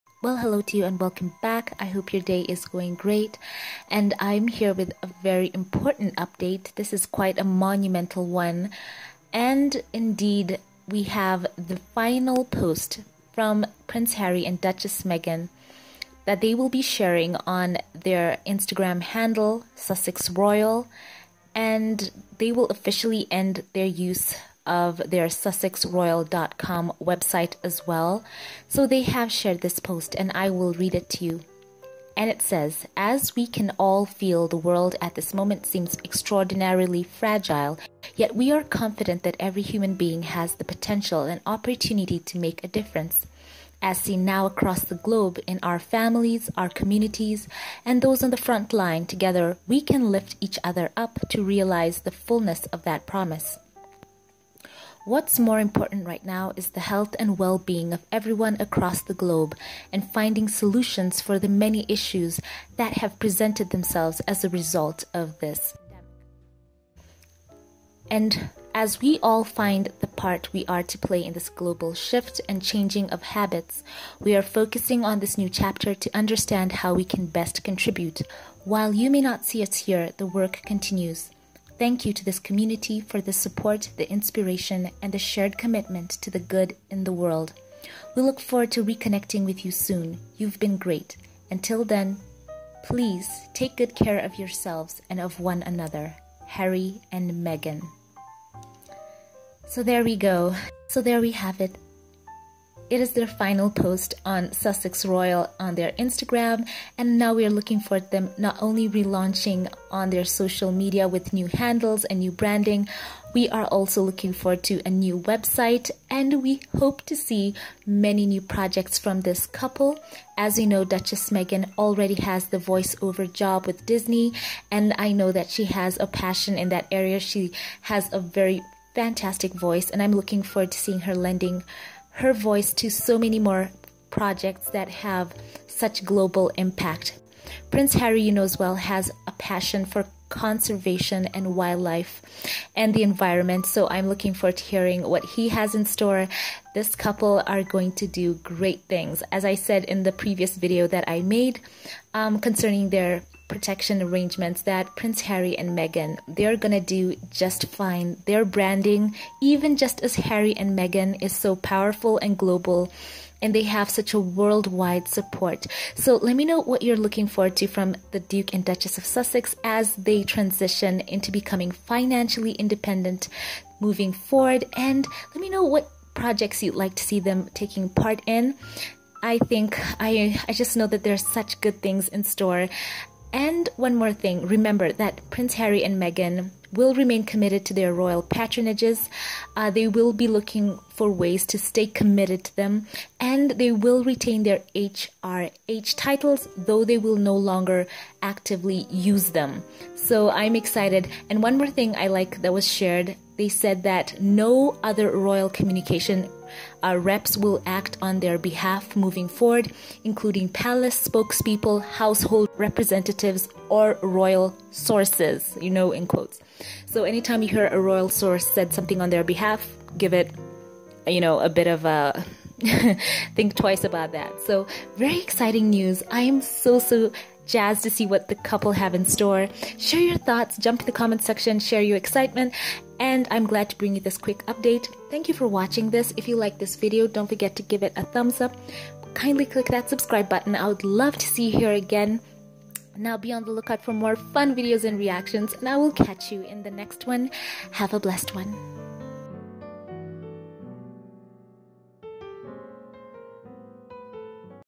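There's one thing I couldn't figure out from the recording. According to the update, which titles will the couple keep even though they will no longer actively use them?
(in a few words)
HRH titles.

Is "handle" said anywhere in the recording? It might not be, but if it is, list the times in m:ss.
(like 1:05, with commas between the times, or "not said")
0:19, 1:51.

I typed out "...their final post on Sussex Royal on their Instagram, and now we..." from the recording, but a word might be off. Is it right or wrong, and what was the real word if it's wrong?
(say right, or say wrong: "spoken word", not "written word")
right.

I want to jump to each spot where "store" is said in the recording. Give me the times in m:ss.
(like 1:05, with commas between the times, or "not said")
2:25, 3:02, 3:49.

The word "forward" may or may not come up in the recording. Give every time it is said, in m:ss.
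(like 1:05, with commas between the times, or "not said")
1:28, 1:54, 2:10, 2:24, 2:47, 2:54, 3:29.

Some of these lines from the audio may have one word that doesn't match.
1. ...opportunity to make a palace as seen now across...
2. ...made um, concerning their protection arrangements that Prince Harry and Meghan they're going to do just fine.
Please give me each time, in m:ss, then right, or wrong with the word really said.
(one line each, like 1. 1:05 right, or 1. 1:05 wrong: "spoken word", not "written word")
1. 0:41 wrong: "difference", not "palace"
2. 2:31 right.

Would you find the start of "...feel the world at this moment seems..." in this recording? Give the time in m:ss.
0:34.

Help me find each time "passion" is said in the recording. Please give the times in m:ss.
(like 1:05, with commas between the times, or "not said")
2:06, 2:19.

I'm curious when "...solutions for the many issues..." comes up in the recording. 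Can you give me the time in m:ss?
1:00.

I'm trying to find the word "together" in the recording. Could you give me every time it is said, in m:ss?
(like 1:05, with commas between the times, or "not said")
0:49.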